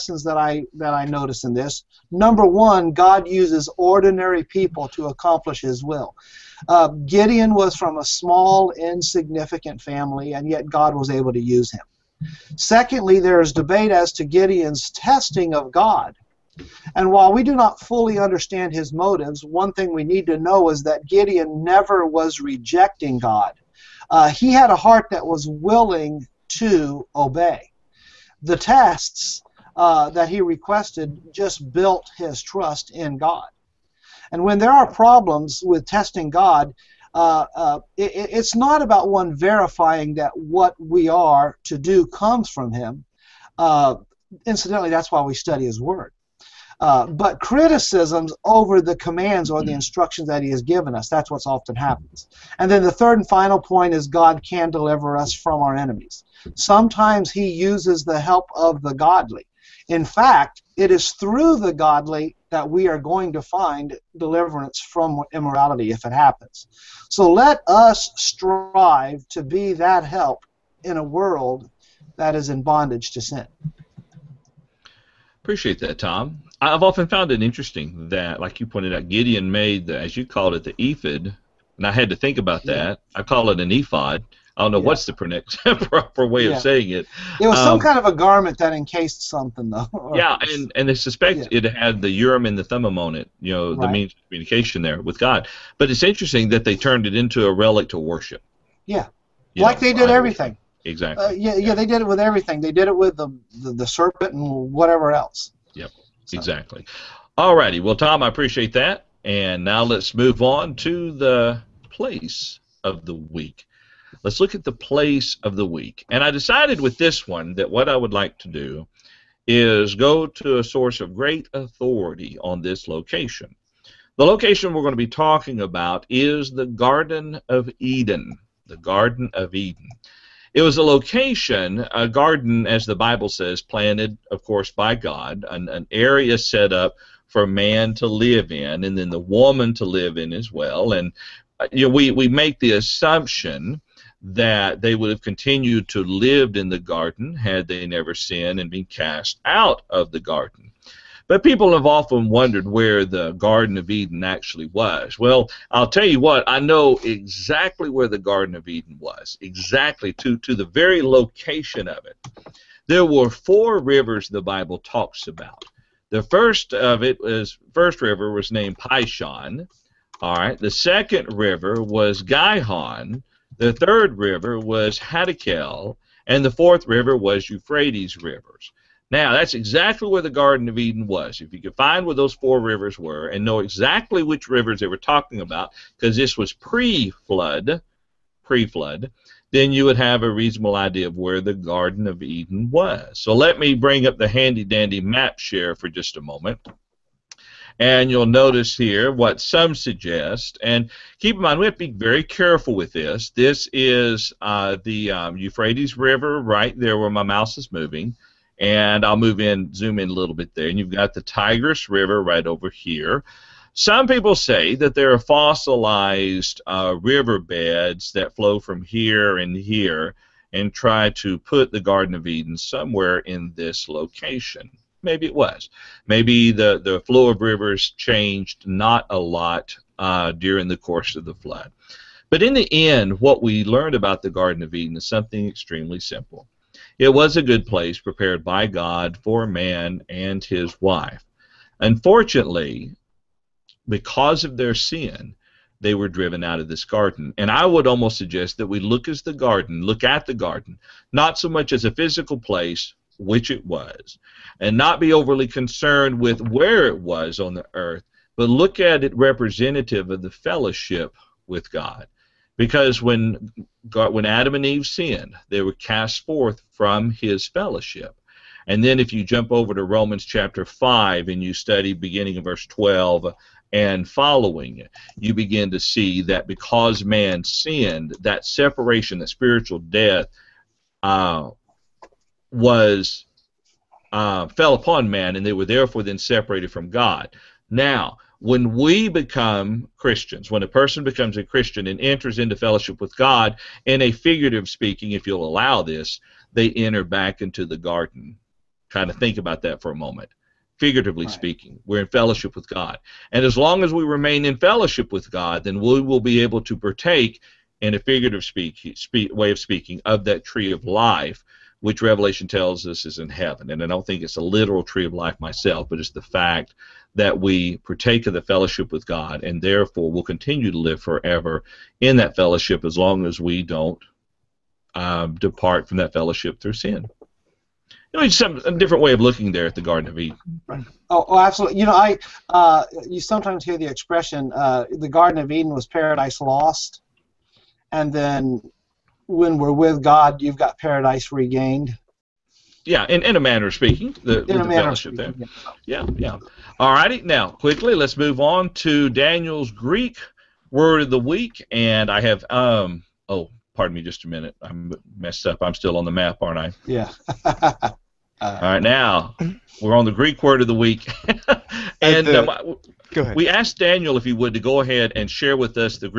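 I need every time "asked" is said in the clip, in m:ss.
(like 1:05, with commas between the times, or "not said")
6:03.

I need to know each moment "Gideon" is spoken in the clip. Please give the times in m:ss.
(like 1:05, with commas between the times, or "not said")
0:07, 0:14, 0:21, 1:19.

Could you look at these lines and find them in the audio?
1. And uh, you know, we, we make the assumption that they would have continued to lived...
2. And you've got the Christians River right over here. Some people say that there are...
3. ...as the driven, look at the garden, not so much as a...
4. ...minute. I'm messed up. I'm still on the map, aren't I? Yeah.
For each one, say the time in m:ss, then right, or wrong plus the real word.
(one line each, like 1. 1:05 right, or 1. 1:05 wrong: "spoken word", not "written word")
1. 2:20 right
2. 3:30 wrong: "Tigris", not "Christians"
3. 4:09 wrong: "garden", not "driven"
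4. 5:54 right.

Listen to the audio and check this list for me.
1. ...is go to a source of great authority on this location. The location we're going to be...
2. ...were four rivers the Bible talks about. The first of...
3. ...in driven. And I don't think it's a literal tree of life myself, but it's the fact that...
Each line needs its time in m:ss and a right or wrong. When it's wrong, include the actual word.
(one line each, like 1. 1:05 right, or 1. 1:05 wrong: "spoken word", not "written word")
1. 1:59 right
2. 2:43 right
3. 5:13 wrong: "heaven", not "driven".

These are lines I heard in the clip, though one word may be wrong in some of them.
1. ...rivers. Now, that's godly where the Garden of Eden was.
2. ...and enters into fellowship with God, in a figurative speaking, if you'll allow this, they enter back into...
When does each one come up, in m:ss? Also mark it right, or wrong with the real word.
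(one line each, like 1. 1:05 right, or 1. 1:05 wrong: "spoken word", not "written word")
1. 2:58 wrong: "exactly", not "godly"
2. 4:51 right.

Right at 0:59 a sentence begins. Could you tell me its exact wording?
In fact, it is through the godly that we are going to find deliverance from immorality if it happens.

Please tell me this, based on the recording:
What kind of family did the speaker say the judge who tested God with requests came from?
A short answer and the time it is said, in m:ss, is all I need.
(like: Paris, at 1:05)
small, insignificant family, at 0:08.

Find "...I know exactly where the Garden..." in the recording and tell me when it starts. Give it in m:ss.
2:36.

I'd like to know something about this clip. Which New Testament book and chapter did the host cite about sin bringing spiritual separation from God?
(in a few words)
Romans 5.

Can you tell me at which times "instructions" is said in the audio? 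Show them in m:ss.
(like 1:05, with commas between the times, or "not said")
0:49.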